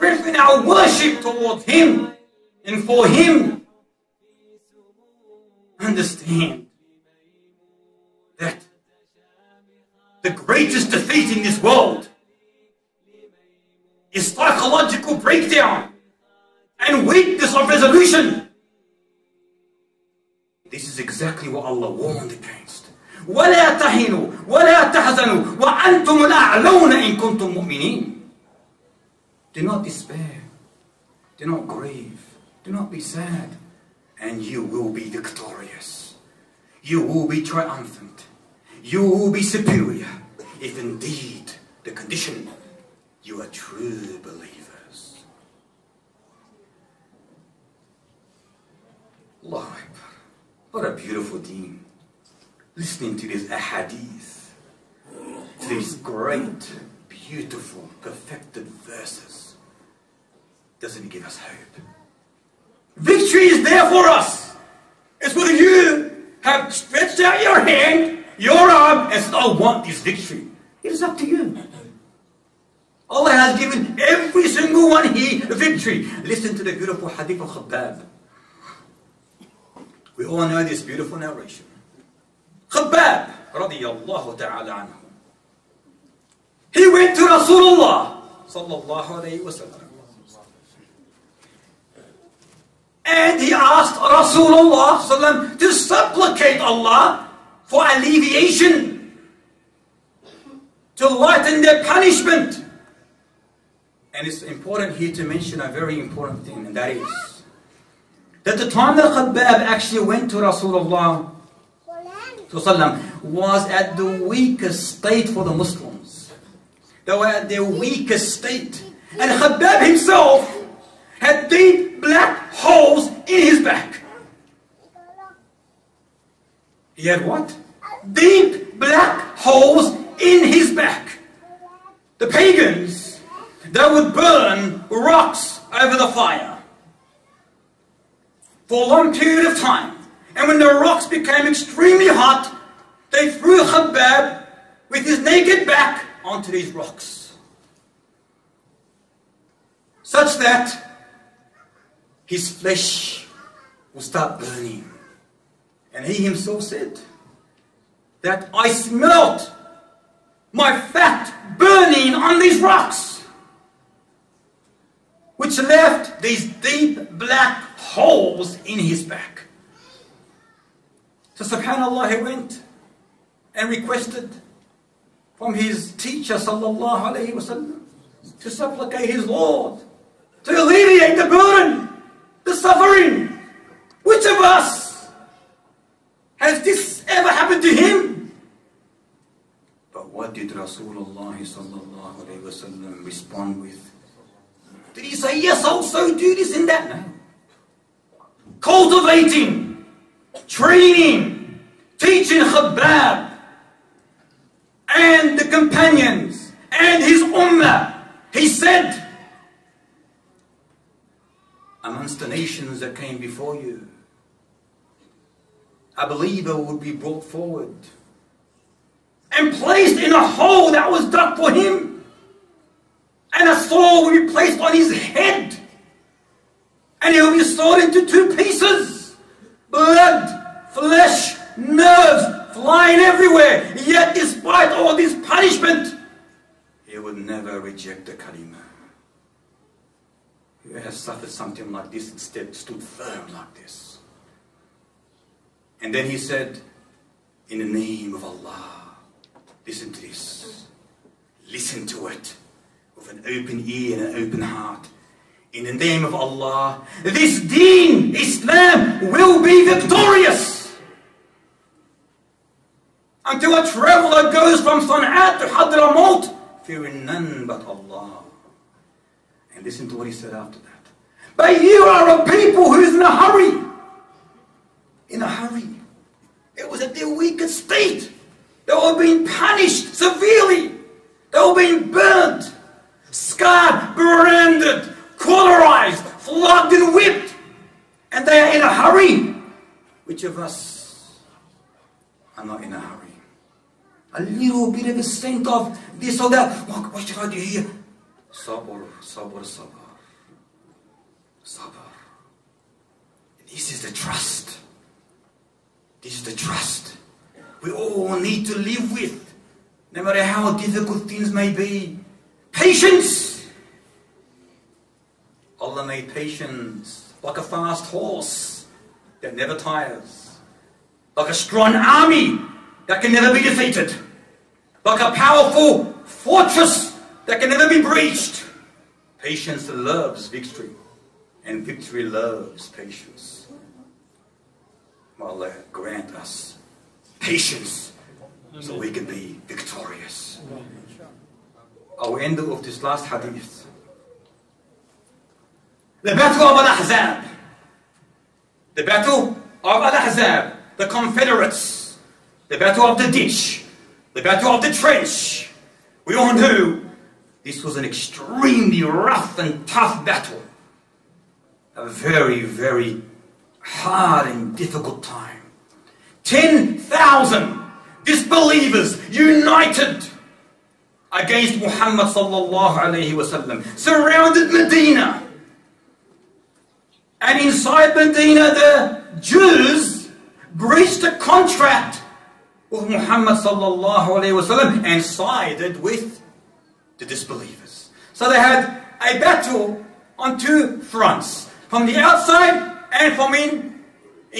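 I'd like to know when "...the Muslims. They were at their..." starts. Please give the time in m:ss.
1:55.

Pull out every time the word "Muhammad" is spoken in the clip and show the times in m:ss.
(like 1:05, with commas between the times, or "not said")
6:11, 6:22.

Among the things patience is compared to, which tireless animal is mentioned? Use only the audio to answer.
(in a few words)
Fast horse.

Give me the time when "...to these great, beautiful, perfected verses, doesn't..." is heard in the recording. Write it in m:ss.
0:55.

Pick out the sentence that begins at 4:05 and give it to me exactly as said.
And then he said, In the name of Allah, listen to this, listen to it an open ear and an open heart.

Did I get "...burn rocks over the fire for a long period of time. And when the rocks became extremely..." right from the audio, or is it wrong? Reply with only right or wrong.
right.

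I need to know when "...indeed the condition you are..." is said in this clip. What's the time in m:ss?
0:40.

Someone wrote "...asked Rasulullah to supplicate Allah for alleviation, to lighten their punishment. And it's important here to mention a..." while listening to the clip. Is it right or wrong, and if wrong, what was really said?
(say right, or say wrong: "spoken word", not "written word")
right.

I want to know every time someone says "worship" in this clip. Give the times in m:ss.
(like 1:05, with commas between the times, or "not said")
0:00.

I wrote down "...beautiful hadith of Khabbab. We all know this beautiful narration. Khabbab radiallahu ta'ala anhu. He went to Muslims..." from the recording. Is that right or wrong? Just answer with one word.
wrong.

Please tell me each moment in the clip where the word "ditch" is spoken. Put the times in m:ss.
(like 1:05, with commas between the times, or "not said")
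5:53.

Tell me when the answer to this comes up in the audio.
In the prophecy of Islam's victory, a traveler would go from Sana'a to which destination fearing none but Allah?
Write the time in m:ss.
4:25.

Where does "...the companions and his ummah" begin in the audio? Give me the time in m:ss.
3:25.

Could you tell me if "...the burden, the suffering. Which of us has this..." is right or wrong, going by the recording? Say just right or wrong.
right.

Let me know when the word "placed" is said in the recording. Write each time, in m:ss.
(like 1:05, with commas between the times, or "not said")
3:39, 3:44.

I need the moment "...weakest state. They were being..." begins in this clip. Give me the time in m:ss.
4:37.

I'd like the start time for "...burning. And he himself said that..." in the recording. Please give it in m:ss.
2:34.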